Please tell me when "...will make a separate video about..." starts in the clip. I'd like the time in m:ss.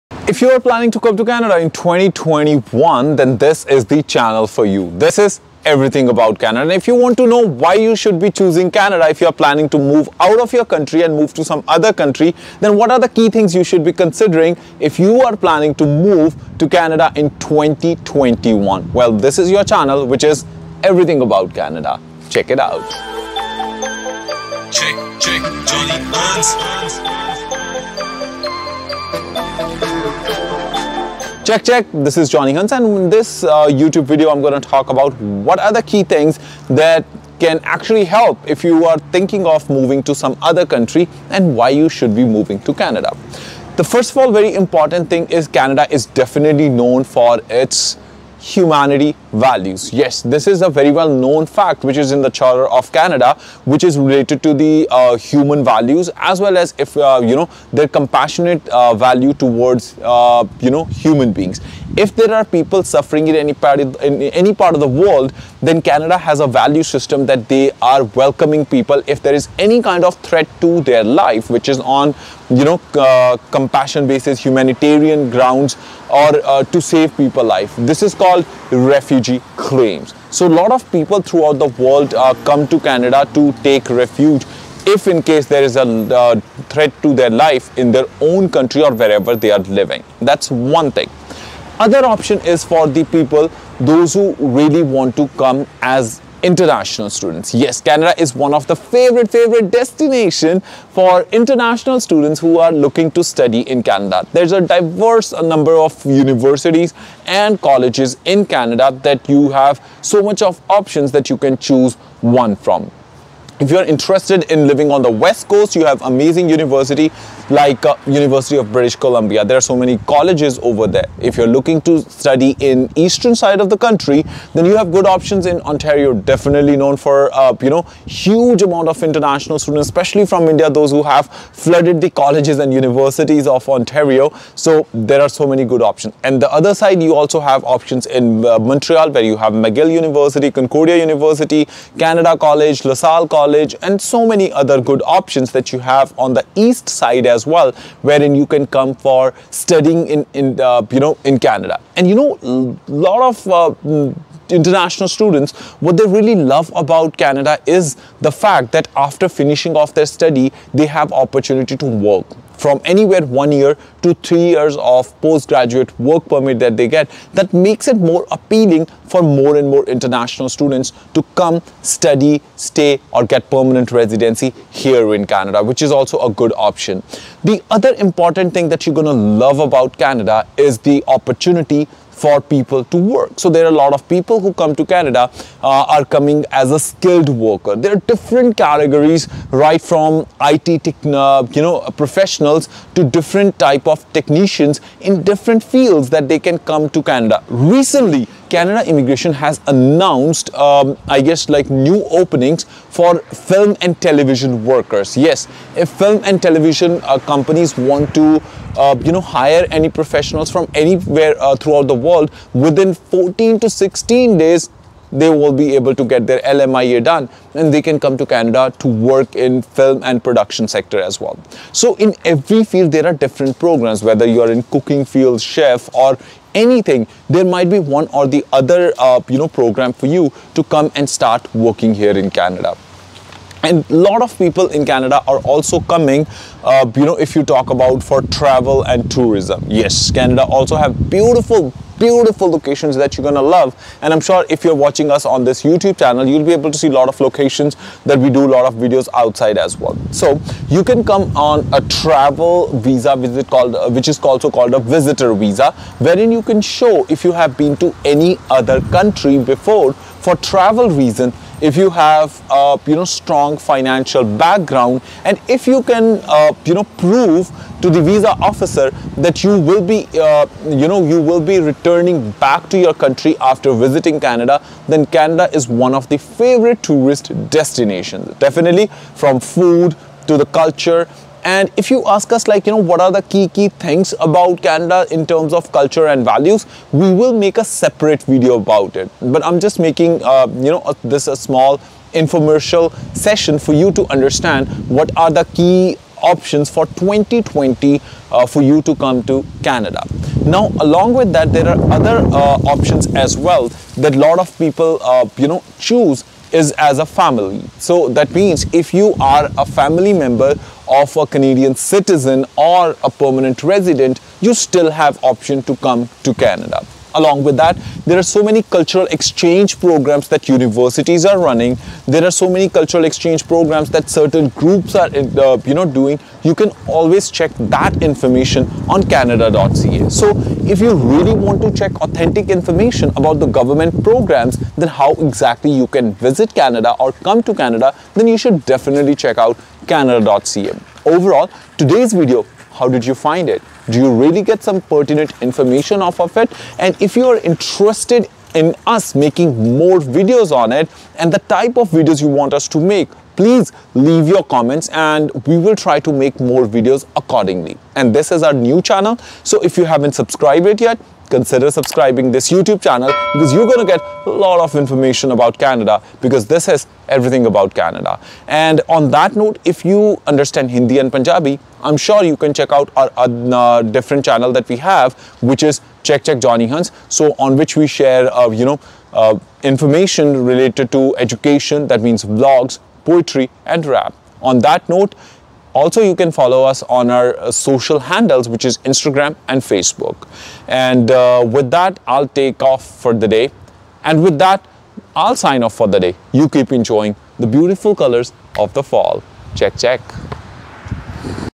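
4:47.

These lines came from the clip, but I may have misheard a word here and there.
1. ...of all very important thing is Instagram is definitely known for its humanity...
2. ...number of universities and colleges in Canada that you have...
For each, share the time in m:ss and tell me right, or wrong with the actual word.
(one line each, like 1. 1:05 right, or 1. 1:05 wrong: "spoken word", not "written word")
1. 0:44 wrong: "Canada", not "Instagram"
2. 1:45 right.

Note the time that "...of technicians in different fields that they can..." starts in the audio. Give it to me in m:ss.
3:13.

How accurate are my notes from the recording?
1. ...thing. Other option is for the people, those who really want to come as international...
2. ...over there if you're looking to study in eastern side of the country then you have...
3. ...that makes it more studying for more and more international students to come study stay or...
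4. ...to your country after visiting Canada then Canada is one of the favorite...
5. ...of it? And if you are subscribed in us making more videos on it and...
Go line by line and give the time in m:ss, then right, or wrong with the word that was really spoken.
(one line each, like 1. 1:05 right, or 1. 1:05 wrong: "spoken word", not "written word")
1. 1:30 right
2. 2:00 right
3. 2:47 wrong: "appealing", not "studying"
4. 4:32 right
5. 5:46 wrong: "interested", not "subscribed".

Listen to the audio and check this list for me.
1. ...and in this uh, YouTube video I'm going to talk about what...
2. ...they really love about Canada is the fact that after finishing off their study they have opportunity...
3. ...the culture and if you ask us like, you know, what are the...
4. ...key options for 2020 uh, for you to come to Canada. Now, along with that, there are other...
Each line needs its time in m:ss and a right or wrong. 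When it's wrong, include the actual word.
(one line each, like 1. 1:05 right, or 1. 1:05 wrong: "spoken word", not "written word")
1. 0:32 right
2. 2:35 right
3. 4:40 right
4. 4:55 right.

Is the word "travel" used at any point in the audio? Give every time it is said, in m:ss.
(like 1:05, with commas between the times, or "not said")
3:58, 4:11, 4:20.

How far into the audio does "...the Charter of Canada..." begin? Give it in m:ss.
0:52.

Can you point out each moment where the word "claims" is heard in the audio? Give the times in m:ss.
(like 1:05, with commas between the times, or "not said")
1:19.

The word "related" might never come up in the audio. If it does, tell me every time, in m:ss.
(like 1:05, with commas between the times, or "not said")
0:53, 6:20.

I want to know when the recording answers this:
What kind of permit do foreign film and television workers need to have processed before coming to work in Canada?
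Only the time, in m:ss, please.
3:36.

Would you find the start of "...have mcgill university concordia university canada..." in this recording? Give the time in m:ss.
2:19.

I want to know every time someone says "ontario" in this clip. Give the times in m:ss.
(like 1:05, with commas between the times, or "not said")
2:05, 2:13.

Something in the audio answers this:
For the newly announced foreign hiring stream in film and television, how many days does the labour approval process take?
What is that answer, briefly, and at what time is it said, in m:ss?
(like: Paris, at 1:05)
14 to 16 days, at 3:32.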